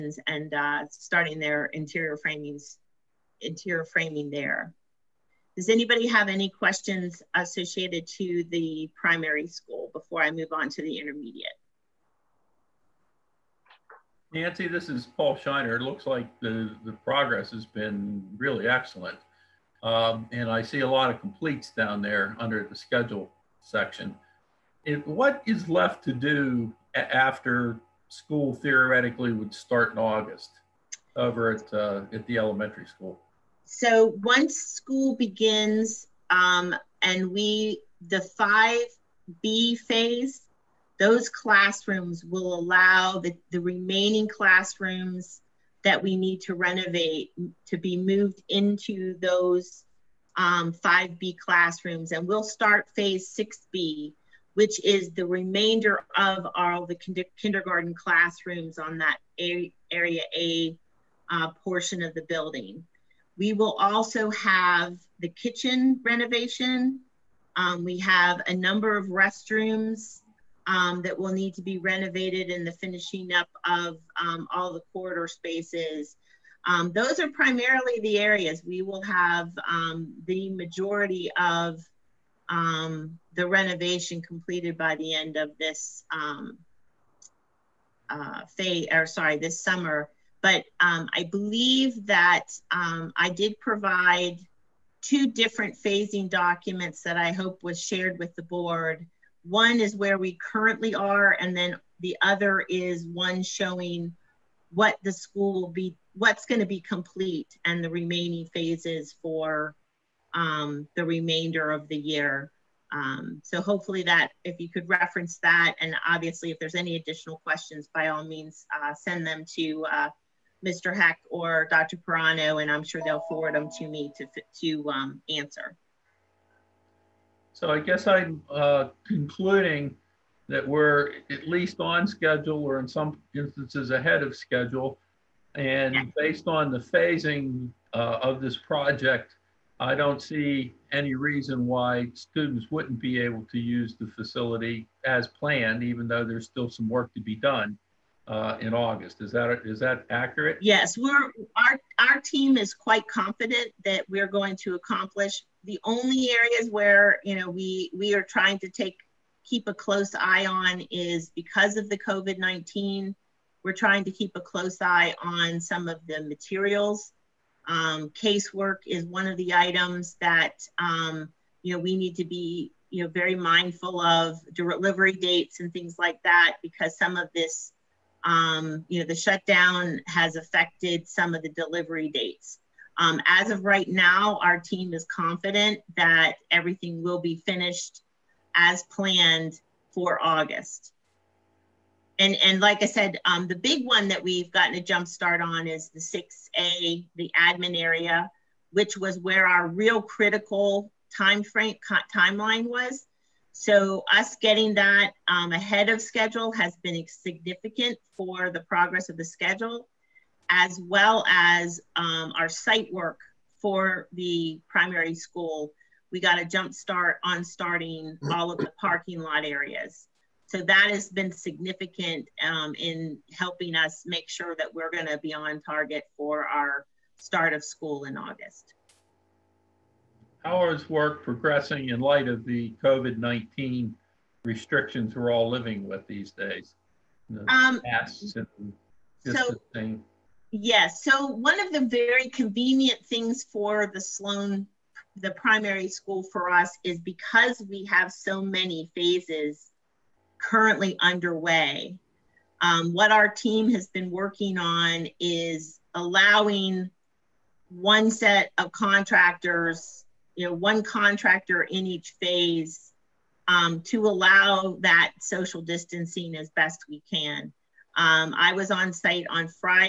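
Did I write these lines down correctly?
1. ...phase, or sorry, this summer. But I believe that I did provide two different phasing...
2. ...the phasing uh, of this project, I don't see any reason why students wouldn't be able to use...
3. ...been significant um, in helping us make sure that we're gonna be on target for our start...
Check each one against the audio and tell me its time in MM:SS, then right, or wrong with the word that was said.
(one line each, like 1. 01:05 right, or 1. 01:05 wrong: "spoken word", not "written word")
1. 01:28 right
2. 02:16 right
3. 03:41 right.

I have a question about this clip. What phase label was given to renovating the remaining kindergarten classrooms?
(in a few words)
6B.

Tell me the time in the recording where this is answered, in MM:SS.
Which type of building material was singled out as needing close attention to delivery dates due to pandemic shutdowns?
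02:48.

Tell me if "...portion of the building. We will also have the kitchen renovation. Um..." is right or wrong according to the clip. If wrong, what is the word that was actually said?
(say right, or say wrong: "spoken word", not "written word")
right.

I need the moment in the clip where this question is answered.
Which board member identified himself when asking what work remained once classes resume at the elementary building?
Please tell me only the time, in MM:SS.
00:15.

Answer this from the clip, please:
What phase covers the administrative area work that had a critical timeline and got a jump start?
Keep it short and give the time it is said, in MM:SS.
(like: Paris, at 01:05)
6A, at 03:15.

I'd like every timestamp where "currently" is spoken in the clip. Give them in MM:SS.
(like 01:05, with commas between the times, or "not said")
01:40, 04:10.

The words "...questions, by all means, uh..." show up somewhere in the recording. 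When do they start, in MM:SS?
01:57.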